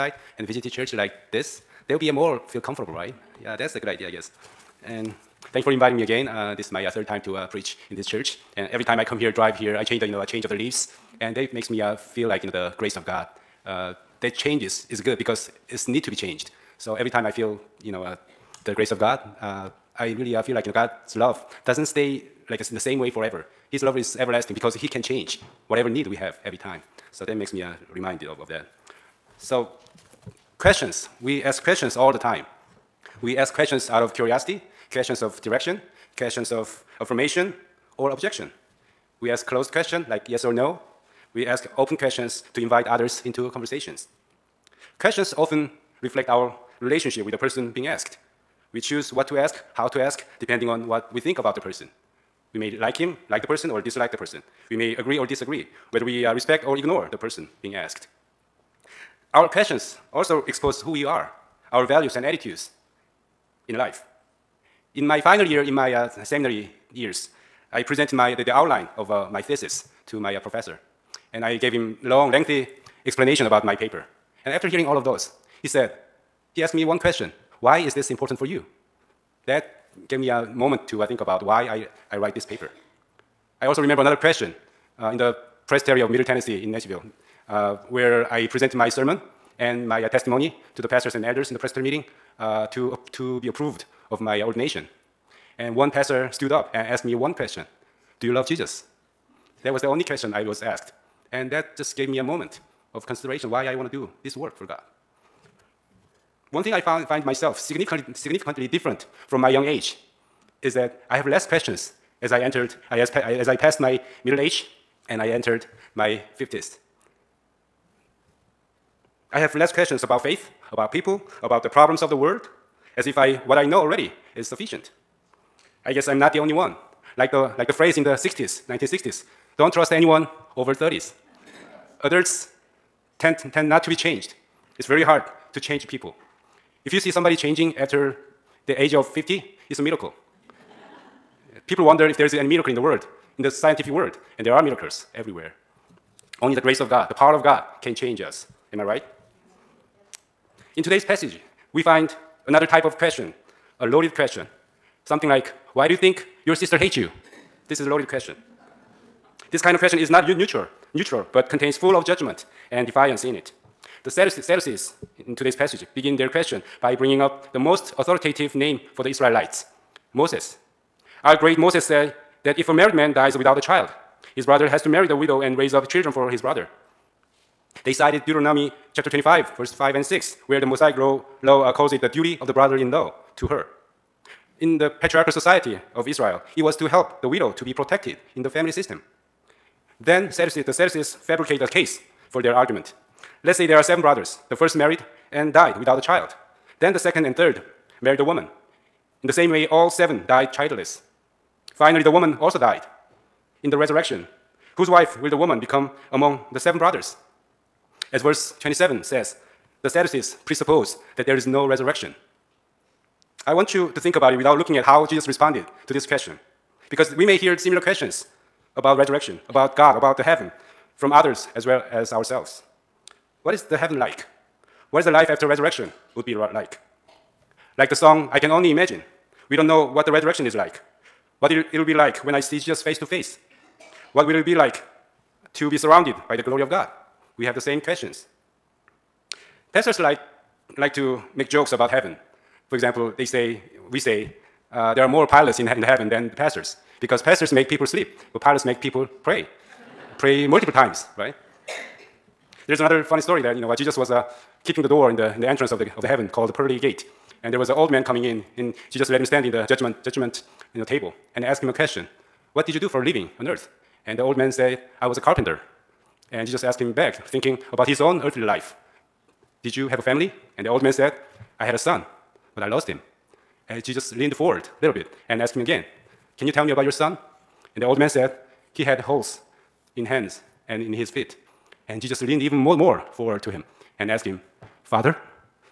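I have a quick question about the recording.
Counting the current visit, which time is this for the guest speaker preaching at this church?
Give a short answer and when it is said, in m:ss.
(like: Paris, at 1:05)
3rd, at 0:06.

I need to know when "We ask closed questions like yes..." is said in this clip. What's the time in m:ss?
0:39.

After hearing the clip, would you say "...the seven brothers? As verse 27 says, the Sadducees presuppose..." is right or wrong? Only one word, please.
right.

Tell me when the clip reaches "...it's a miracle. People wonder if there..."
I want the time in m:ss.
2:19.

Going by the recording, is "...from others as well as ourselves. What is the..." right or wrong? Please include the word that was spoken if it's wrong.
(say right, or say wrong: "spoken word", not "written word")
right.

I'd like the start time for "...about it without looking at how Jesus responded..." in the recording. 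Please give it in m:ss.
3:34.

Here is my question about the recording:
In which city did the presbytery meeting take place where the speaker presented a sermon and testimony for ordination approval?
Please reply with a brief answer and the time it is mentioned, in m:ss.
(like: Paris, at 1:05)
Nashville, at 1:26.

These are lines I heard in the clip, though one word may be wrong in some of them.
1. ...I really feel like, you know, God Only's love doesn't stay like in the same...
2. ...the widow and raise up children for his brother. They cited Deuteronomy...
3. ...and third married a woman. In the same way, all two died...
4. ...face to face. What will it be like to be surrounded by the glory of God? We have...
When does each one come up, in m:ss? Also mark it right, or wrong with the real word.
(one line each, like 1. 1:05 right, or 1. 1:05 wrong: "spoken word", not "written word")
1. 0:19 wrong: "God", not "Only"
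2. 2:55 right
3. 3:17 wrong: "seven", not "two"
4. 3:52 right.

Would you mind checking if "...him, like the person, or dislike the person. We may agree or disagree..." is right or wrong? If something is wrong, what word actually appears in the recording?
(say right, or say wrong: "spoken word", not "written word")
right.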